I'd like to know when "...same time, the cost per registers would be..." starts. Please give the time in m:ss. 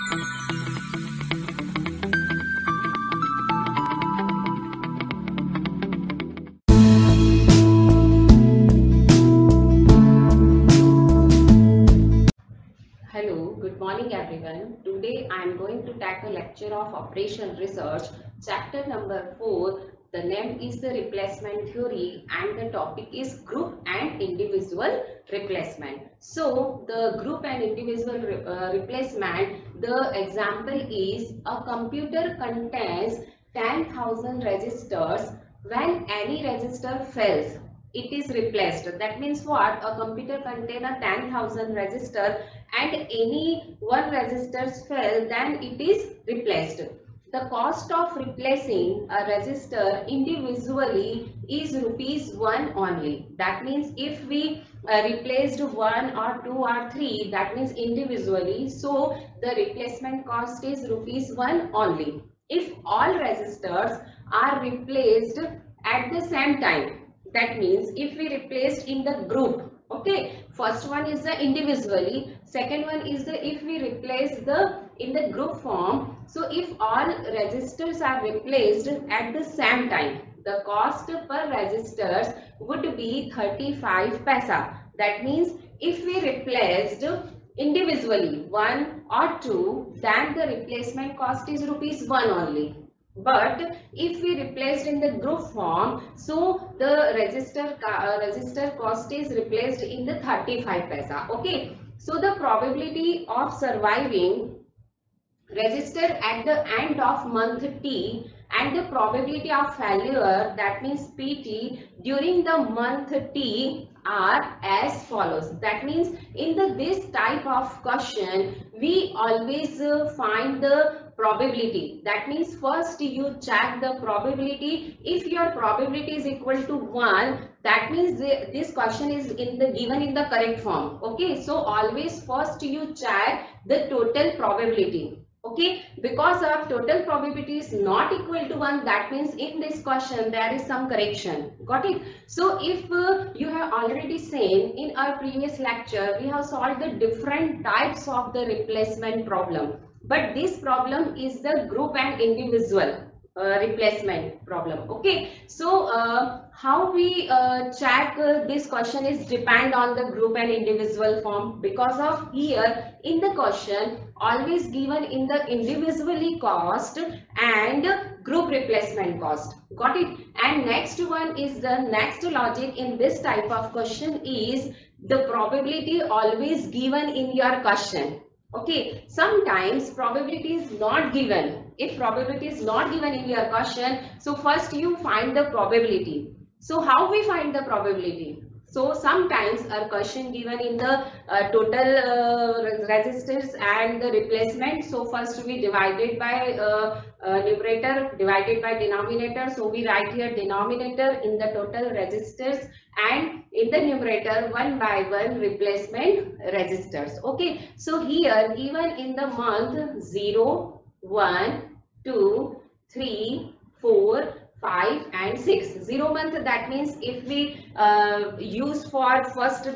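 1:19.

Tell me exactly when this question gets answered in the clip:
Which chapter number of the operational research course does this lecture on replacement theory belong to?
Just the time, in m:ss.
0:18.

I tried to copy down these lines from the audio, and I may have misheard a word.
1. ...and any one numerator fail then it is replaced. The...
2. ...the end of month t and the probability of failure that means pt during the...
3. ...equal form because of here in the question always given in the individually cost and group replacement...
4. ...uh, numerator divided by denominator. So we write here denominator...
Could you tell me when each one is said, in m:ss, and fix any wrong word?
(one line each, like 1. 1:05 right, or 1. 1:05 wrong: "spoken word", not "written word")
1. 0:42 wrong: "resistor", not "numerator"
2. 1:46 right
3. 2:40 wrong: "individual", not "equal"
4. 3:17 right.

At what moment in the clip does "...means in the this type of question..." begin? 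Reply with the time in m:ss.
1:55.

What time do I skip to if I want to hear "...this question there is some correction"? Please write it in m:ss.
2:19.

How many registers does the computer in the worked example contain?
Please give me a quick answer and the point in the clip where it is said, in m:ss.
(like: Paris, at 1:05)
10,000, at 0:33.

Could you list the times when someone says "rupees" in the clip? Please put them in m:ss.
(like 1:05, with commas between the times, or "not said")
0:51, 1:00, 1:31.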